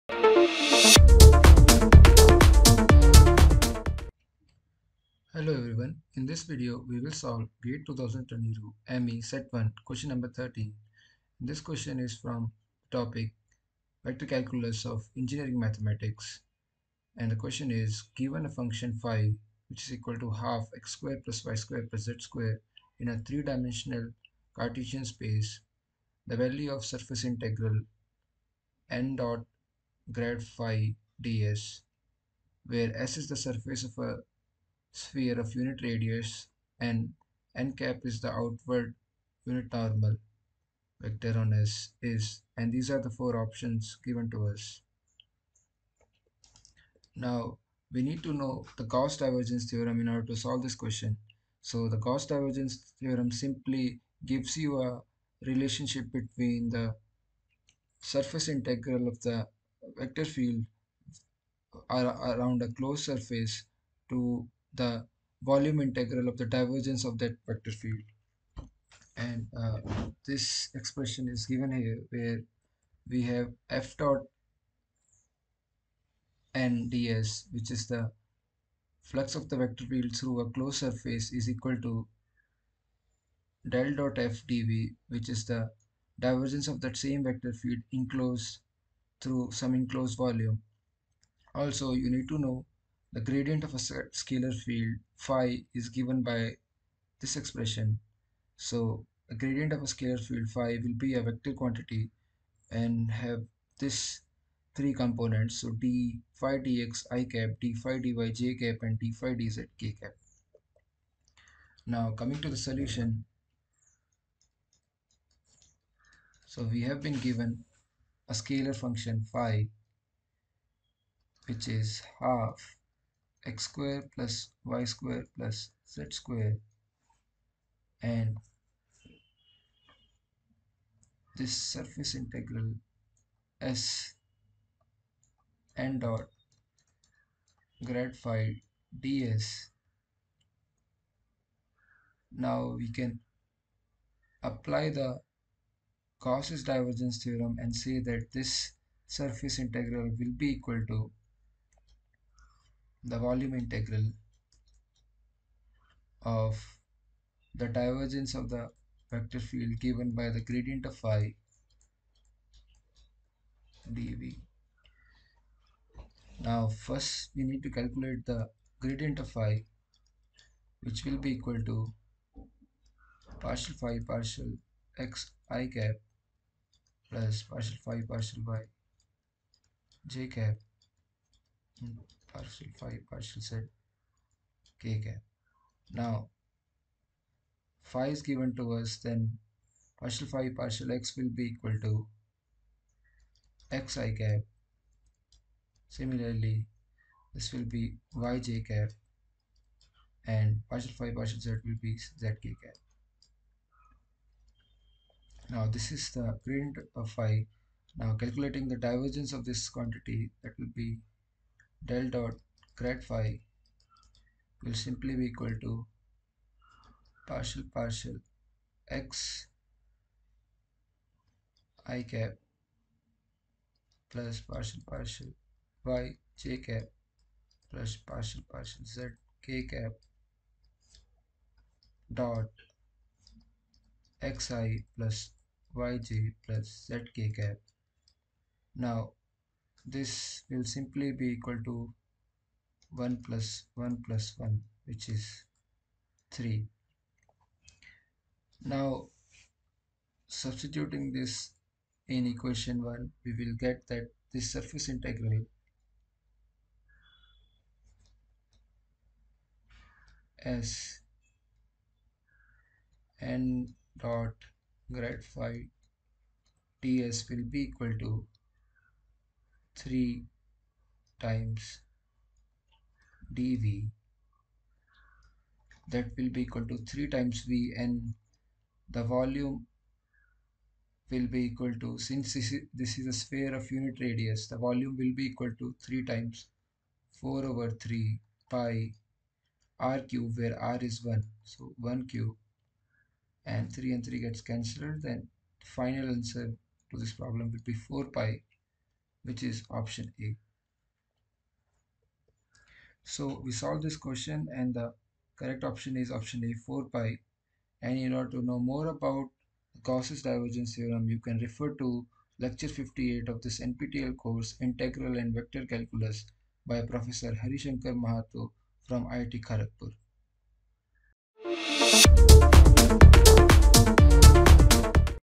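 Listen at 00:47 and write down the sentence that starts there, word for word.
Now we need to know the Gauss divergence theorem in order to solve this question.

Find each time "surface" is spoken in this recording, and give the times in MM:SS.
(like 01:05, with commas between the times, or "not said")
00:26, 00:33, 00:58, 01:03, 01:20, 02:11, 02:29, 04:14.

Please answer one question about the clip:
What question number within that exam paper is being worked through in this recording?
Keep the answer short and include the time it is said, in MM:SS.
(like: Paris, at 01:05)
13, at 00:10.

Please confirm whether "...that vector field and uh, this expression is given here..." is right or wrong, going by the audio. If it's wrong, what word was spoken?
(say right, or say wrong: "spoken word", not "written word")
right.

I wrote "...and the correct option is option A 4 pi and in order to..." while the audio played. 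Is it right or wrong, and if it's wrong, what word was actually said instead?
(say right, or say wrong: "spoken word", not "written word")
right.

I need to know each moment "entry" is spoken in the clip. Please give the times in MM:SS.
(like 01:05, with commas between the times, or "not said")
not said.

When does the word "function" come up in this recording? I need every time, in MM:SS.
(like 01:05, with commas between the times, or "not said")
00:18, 01:58.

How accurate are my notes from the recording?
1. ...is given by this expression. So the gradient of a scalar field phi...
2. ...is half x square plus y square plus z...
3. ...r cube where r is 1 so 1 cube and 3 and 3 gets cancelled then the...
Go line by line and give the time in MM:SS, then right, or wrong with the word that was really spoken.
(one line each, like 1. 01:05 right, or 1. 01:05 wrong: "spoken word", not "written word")
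1. 01:35 right
2. 02:01 right
3. 04:49 right.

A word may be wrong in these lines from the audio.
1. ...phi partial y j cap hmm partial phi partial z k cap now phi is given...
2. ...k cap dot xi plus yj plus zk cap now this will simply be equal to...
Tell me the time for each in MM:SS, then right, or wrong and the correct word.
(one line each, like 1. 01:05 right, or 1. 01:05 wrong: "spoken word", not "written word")
1. 02:57 right
2. 03:49 right.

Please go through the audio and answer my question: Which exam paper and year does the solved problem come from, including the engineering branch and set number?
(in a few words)
GATE 2022 ME Set 1.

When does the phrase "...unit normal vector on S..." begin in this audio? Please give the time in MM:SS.
00:39.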